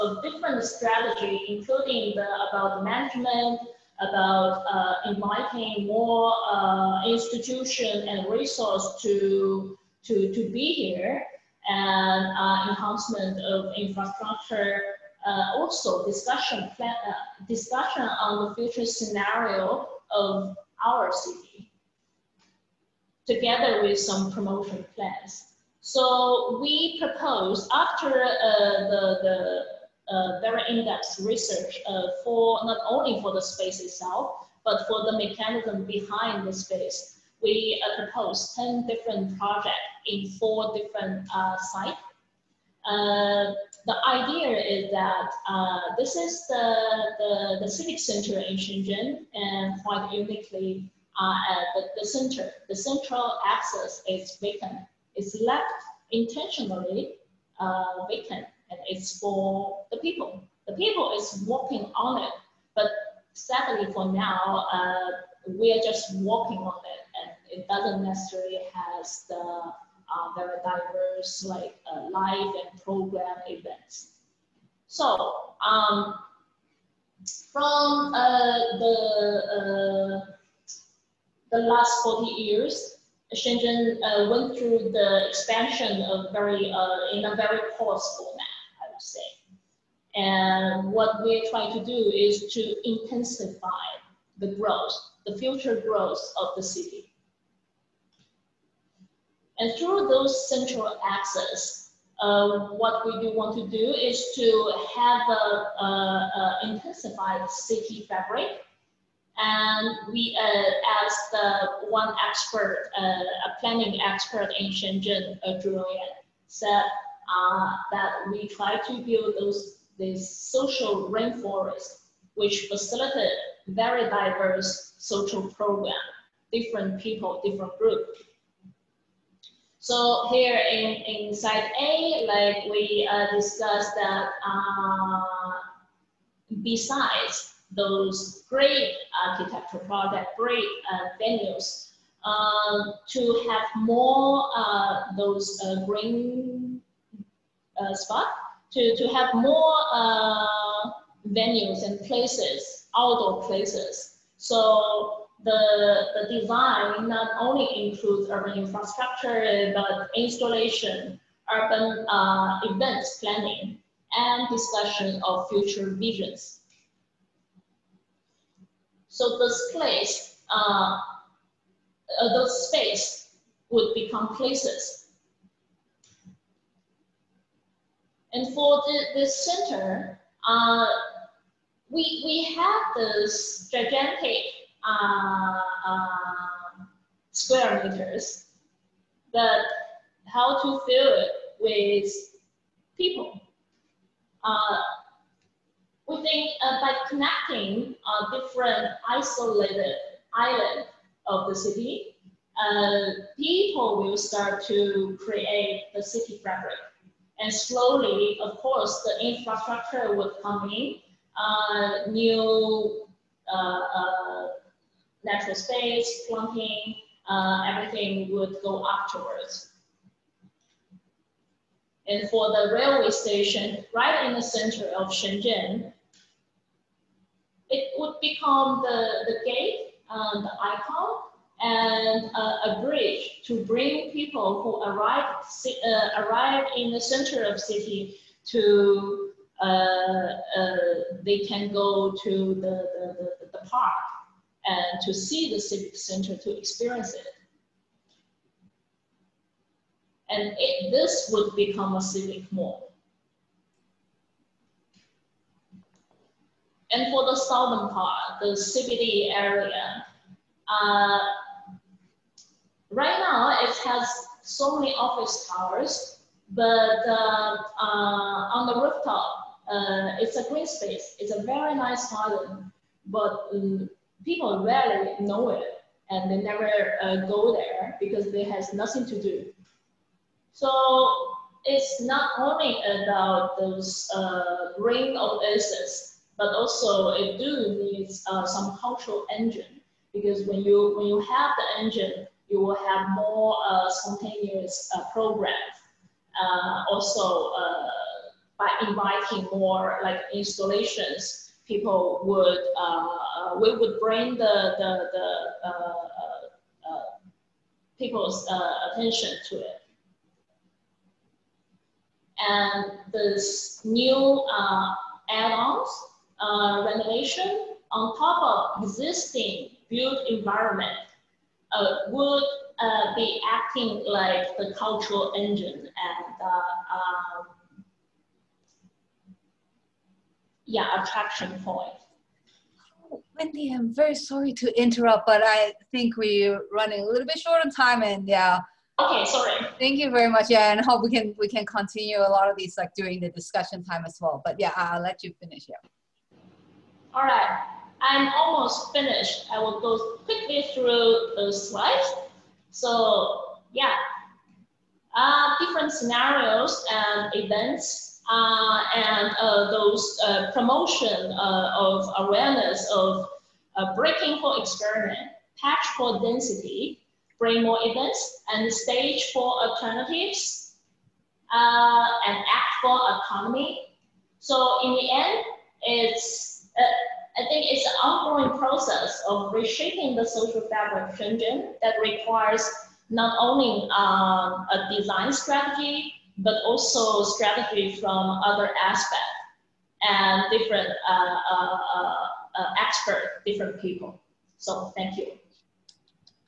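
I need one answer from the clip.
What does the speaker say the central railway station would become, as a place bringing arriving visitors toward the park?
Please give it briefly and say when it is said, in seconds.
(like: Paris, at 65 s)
a civic mall, at 252 s.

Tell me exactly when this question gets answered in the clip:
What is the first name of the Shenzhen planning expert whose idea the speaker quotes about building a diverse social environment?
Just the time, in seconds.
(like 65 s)
115 s.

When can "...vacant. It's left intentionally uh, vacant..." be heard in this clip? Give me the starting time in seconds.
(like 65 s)
54 s.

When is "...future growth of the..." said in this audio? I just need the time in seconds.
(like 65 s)
95 s.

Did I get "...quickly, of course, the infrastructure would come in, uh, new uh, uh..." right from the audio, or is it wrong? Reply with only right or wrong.
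wrong.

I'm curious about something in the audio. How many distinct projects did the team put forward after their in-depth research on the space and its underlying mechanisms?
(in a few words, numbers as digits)
10.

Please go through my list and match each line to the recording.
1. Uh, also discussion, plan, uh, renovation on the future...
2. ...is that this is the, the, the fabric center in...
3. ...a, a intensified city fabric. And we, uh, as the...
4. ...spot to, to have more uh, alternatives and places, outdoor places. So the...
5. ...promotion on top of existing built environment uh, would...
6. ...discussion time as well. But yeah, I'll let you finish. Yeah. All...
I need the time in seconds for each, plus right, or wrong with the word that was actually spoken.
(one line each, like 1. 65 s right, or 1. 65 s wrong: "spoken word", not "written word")
1. 15 s wrong: "discussion", not "renovation"
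2. 44 s wrong: "civic", not "fabric"
3. 105 s right
4. 147 s wrong: "venues", not "alternatives"
5. 316 s wrong: "renovation", not "promotion"
6. 343 s right.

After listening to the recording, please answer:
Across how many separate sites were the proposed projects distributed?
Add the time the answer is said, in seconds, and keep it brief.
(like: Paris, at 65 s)
4, at 40 s.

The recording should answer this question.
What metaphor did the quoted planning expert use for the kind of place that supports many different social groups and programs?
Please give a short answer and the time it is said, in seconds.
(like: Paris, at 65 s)
social rainforest, at 120 s.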